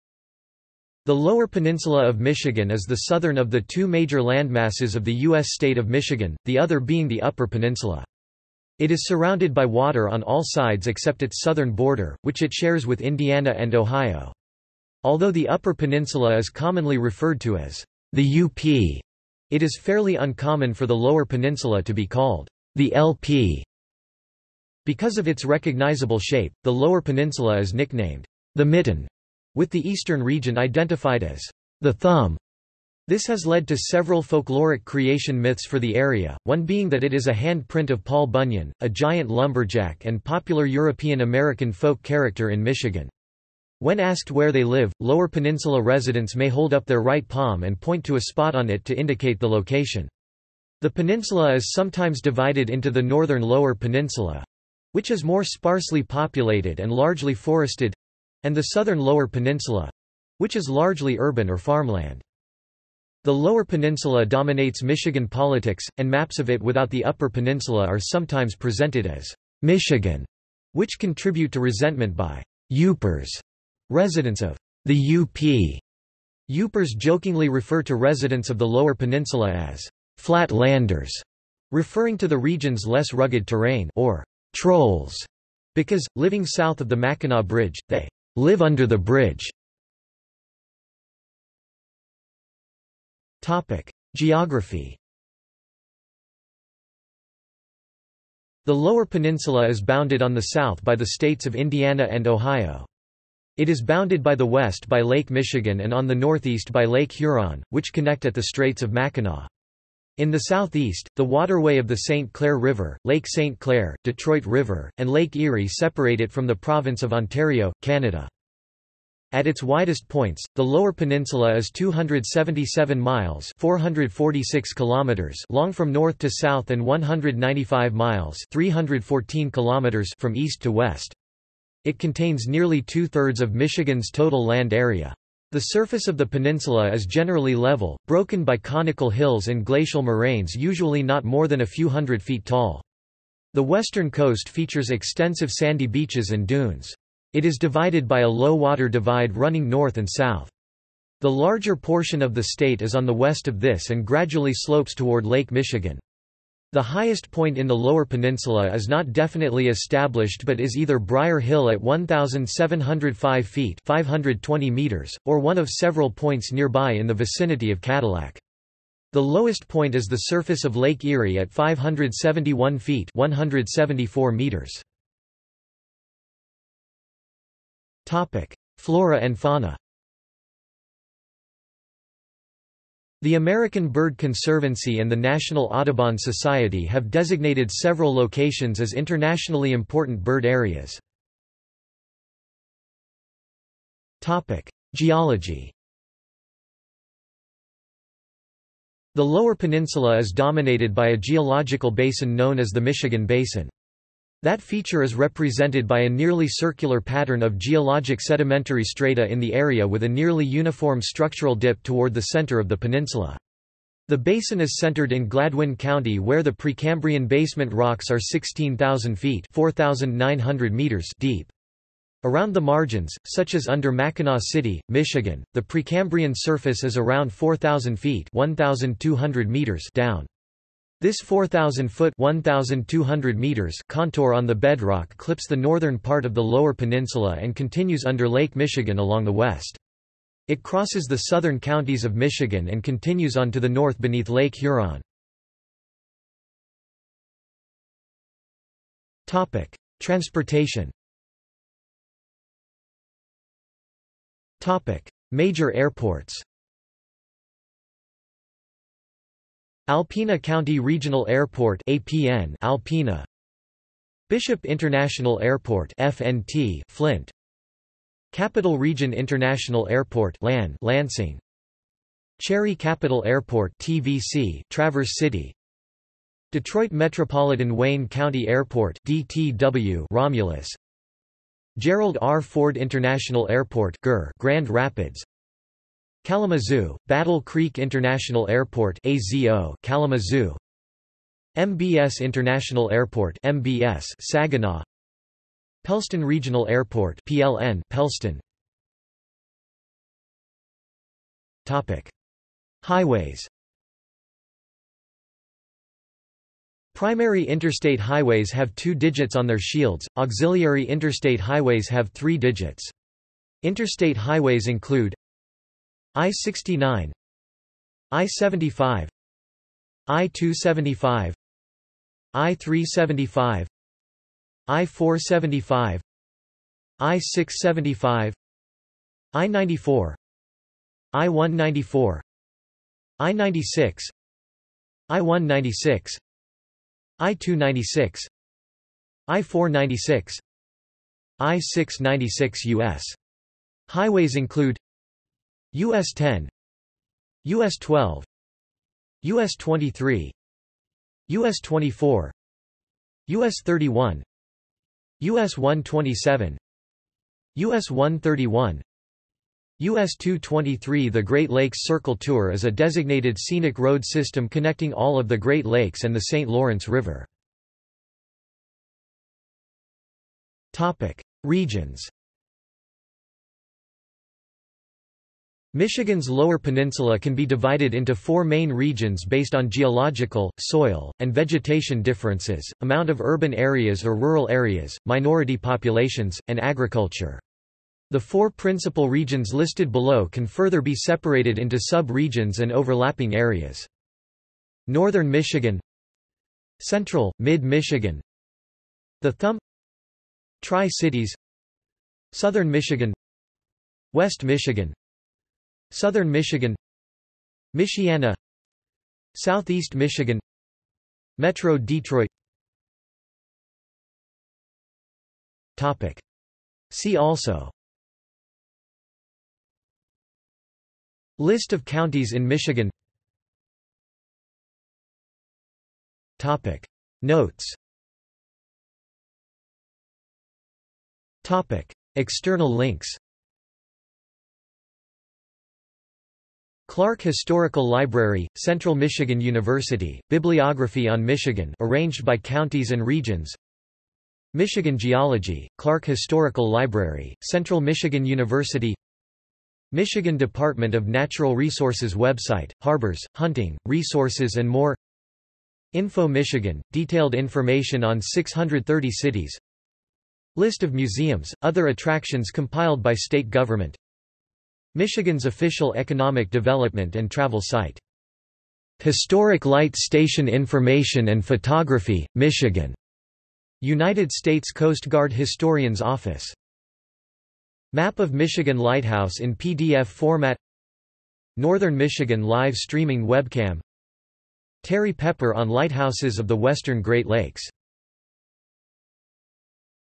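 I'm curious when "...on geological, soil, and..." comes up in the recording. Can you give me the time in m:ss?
6:19.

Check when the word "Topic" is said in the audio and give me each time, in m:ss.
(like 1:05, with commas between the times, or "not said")
5:01, 6:10, 6:55, 7:06, 7:11.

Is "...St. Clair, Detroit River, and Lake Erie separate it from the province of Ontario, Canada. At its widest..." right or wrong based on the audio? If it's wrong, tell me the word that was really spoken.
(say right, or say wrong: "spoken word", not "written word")
right.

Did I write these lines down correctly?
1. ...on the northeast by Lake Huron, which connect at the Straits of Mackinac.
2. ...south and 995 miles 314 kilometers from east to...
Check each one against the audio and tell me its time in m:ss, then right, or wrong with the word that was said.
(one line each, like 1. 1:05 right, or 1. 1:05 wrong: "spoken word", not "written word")
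1. 1:45 right
2. 2:06 wrong: "195", not "995".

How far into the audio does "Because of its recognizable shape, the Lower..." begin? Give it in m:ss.
0:24.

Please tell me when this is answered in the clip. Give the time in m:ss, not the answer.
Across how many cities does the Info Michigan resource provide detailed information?
7:38.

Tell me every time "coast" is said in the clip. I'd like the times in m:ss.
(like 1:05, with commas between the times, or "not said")
2:24, 7:54.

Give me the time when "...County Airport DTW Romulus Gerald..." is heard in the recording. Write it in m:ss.
4:38.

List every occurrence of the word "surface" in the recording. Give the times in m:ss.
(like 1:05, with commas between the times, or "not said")
2:15, 2:50, 3:46.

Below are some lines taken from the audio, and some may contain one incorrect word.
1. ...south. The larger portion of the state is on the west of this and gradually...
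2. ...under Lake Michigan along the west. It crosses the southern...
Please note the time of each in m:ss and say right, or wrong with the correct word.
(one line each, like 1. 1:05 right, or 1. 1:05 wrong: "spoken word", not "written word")
1. 2:30 right
2. 3:58 right.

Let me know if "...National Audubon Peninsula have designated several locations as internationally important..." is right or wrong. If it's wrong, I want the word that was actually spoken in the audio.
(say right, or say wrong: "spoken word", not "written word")
wrong: "Society", not "Peninsula".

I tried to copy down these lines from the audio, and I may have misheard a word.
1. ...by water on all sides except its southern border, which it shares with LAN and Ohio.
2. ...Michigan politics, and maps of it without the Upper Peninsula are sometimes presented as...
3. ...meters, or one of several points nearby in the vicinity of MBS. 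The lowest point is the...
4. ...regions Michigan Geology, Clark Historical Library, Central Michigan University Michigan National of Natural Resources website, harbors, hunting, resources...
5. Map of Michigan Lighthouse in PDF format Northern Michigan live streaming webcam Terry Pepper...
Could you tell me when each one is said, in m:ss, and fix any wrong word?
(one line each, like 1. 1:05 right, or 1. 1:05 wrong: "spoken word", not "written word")
1. 0:09 wrong: "Indiana", not "LAN"
2. 1:04 right
3. 2:44 wrong: "Cadillac", not "MBS"
4. 7:23 wrong: "Department", not "National"
5. 7:57 right.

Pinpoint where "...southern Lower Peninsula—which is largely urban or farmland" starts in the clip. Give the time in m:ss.
0:58.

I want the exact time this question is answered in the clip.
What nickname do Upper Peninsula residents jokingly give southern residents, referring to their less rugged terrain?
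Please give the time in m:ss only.
1:20.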